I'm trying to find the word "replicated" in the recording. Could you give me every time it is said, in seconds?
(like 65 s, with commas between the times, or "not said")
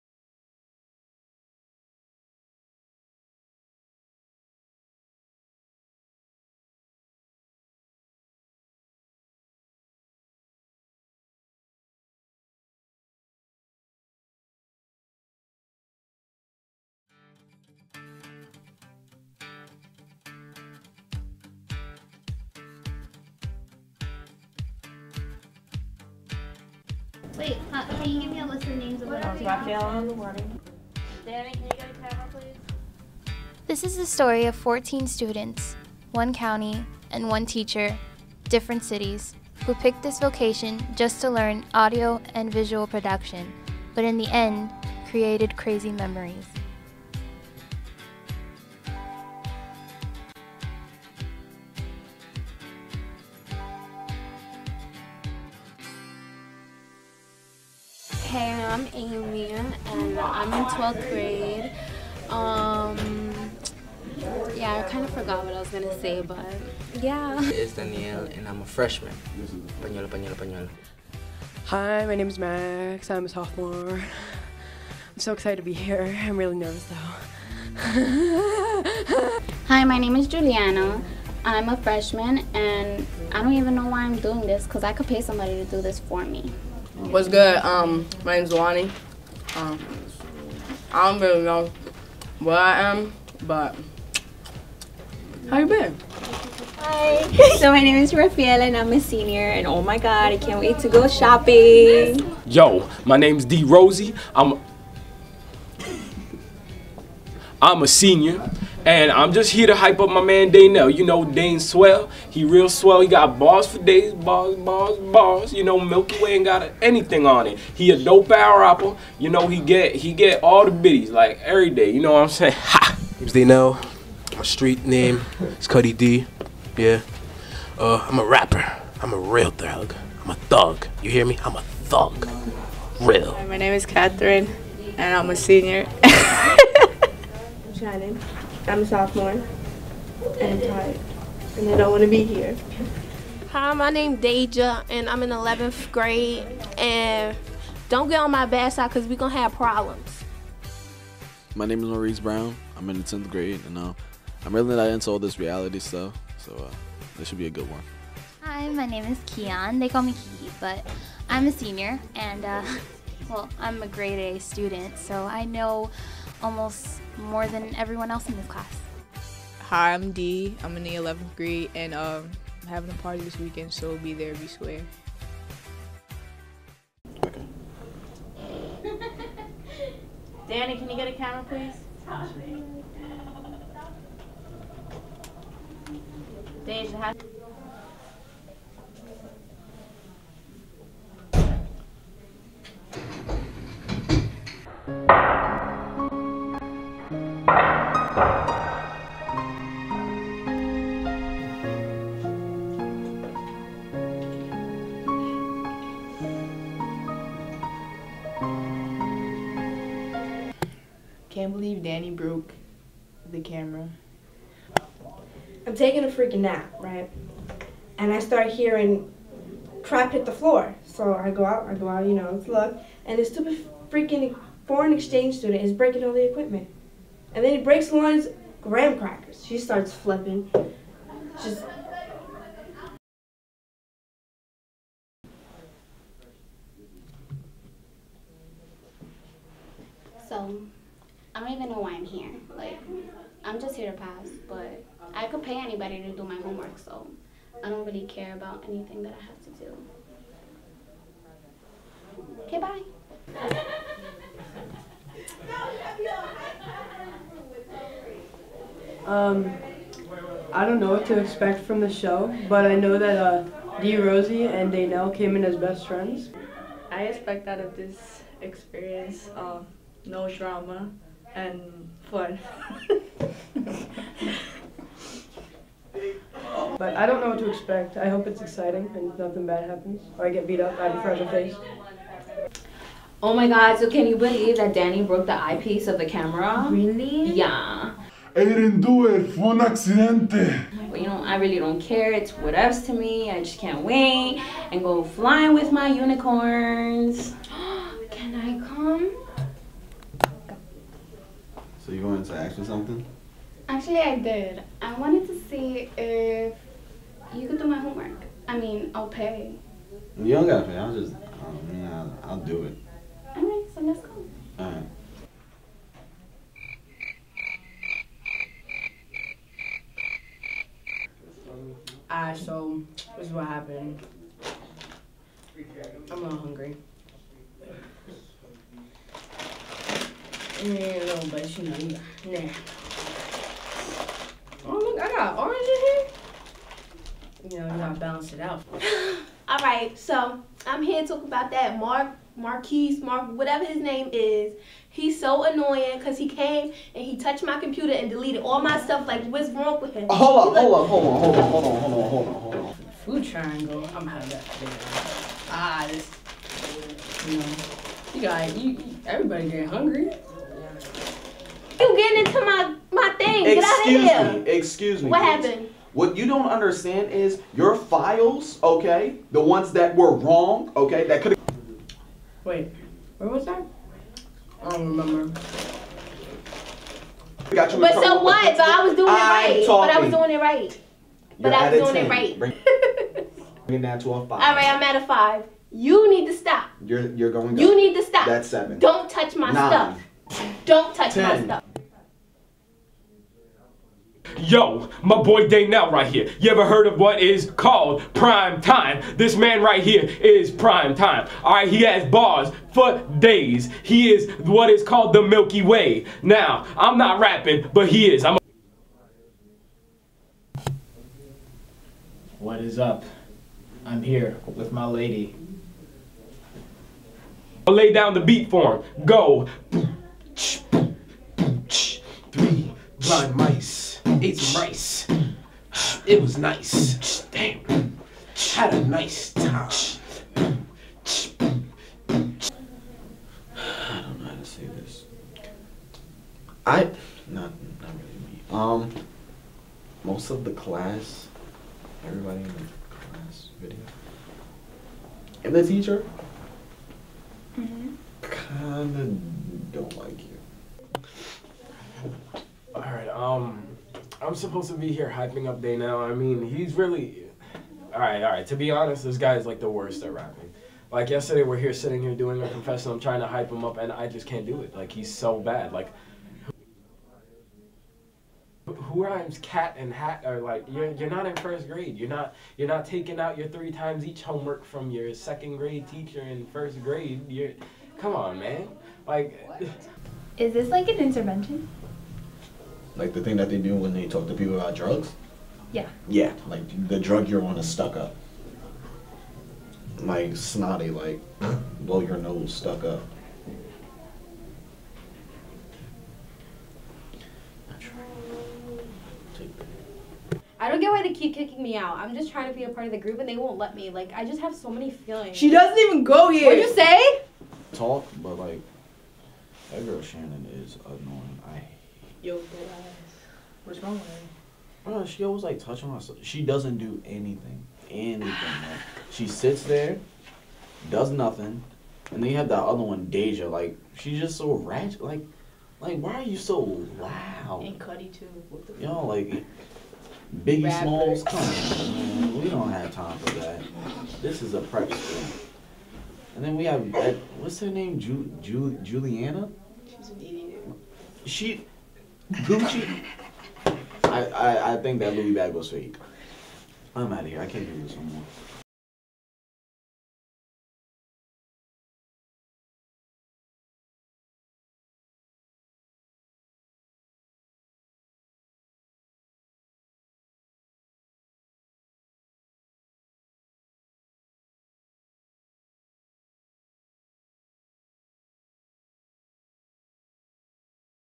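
not said.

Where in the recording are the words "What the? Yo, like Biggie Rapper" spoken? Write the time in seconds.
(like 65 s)
528 s.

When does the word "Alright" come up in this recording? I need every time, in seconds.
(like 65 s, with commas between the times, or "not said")
322 s, 452 s.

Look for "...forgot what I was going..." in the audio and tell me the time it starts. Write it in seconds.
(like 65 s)
65 s.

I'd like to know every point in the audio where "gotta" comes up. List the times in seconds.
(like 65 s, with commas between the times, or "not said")
310 s, 337 s.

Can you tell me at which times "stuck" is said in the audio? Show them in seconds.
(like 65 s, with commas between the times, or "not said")
487 s, 492 s.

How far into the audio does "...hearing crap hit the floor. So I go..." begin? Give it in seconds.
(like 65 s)
218 s.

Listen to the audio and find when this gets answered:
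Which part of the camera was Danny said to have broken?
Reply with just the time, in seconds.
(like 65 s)
285 s.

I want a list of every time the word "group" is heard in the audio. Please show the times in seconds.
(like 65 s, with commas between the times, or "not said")
502 s.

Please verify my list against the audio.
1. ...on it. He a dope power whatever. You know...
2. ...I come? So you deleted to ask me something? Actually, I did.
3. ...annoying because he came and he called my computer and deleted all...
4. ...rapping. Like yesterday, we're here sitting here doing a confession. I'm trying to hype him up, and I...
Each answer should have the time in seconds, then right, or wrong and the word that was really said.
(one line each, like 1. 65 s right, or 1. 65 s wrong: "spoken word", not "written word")
1. 117 s wrong: "rapper", not "whatever"
2. 298 s wrong: "wanted", not "deleted"
3. 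345 s wrong: "touched", not "called"
4. 460 s right.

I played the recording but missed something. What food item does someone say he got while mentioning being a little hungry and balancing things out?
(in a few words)
Orange.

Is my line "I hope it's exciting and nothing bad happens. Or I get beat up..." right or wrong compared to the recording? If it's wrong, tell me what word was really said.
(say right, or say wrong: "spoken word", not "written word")
right.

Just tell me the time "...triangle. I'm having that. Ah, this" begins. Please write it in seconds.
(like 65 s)
353 s.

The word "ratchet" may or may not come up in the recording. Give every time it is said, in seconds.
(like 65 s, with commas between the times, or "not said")
524 s.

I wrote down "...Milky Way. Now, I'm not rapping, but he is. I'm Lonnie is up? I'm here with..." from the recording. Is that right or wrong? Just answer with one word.
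wrong.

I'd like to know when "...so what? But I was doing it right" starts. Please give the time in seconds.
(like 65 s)
377 s.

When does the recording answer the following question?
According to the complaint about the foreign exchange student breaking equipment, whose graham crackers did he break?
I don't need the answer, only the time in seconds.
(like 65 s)
227 s.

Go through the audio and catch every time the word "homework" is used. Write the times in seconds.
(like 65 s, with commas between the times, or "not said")
246 s, 307 s, 474 s.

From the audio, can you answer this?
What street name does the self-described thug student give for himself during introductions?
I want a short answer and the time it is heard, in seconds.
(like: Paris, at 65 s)
Cuddy D, at 125 s.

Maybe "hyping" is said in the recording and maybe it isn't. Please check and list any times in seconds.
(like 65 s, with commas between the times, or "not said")
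455 s.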